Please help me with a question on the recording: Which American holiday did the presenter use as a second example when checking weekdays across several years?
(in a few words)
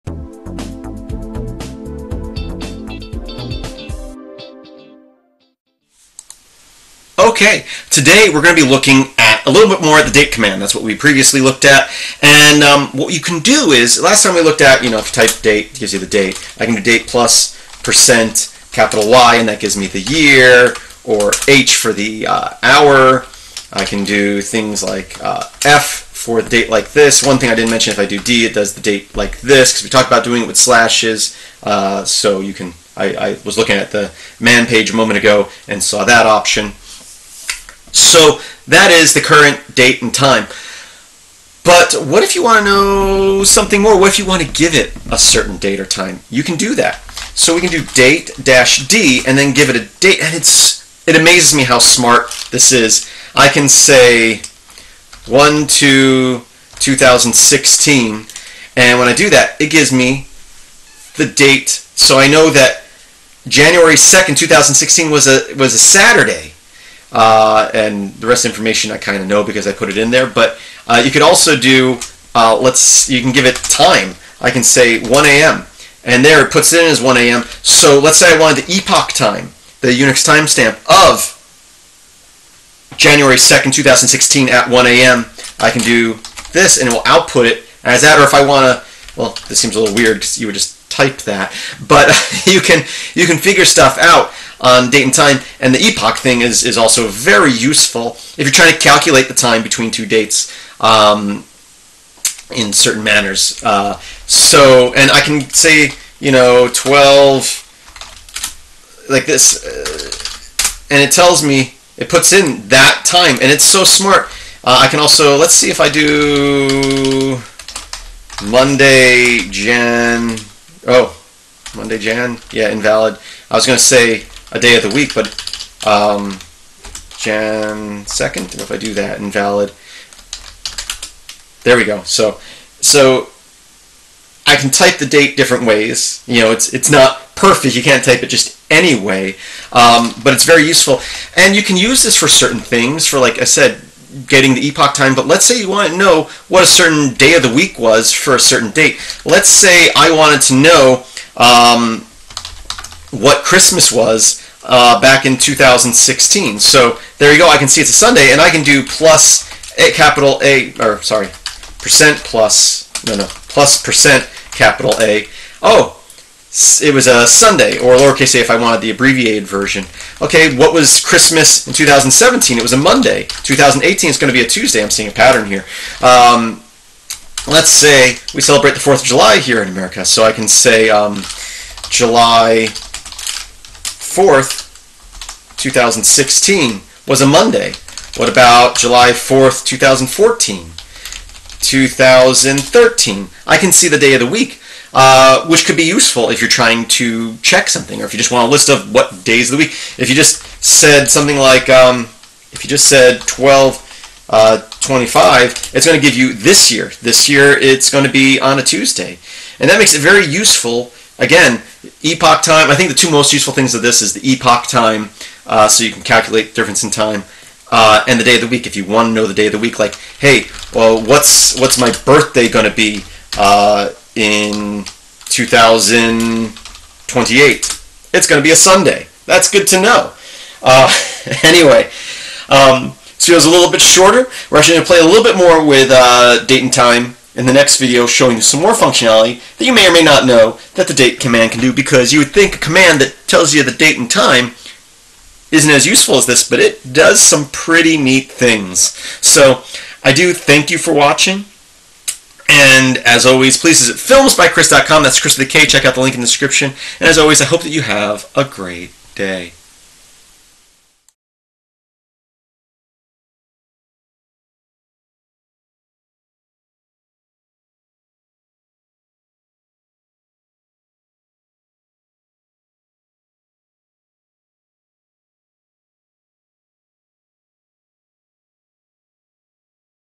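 4th of July.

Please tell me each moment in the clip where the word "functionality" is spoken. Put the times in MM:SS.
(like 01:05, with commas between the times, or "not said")
03:58.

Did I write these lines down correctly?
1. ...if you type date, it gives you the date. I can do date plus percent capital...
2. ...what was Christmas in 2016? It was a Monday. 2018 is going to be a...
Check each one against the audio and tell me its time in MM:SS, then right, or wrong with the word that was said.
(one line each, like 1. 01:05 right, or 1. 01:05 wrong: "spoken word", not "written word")
1. 00:14 right
2. 02:50 wrong: "2017", not "2016".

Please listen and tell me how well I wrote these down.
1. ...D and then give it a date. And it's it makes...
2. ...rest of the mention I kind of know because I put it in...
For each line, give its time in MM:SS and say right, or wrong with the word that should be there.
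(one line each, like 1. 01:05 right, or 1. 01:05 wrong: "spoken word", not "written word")
1. 00:48 wrong: "amazes", not "makes"
2. 01:08 wrong: "information", not "mention".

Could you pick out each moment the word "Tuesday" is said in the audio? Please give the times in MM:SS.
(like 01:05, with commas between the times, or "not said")
02:54, 03:28.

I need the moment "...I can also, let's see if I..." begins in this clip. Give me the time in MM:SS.
01:54.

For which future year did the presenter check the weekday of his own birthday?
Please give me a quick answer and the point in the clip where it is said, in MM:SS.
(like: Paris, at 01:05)
2028, at 03:45.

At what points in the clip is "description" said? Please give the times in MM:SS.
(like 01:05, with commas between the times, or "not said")
04:16.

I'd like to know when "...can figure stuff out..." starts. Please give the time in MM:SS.
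01:33.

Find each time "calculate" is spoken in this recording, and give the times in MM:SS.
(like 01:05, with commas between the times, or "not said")
01:38, 03:36.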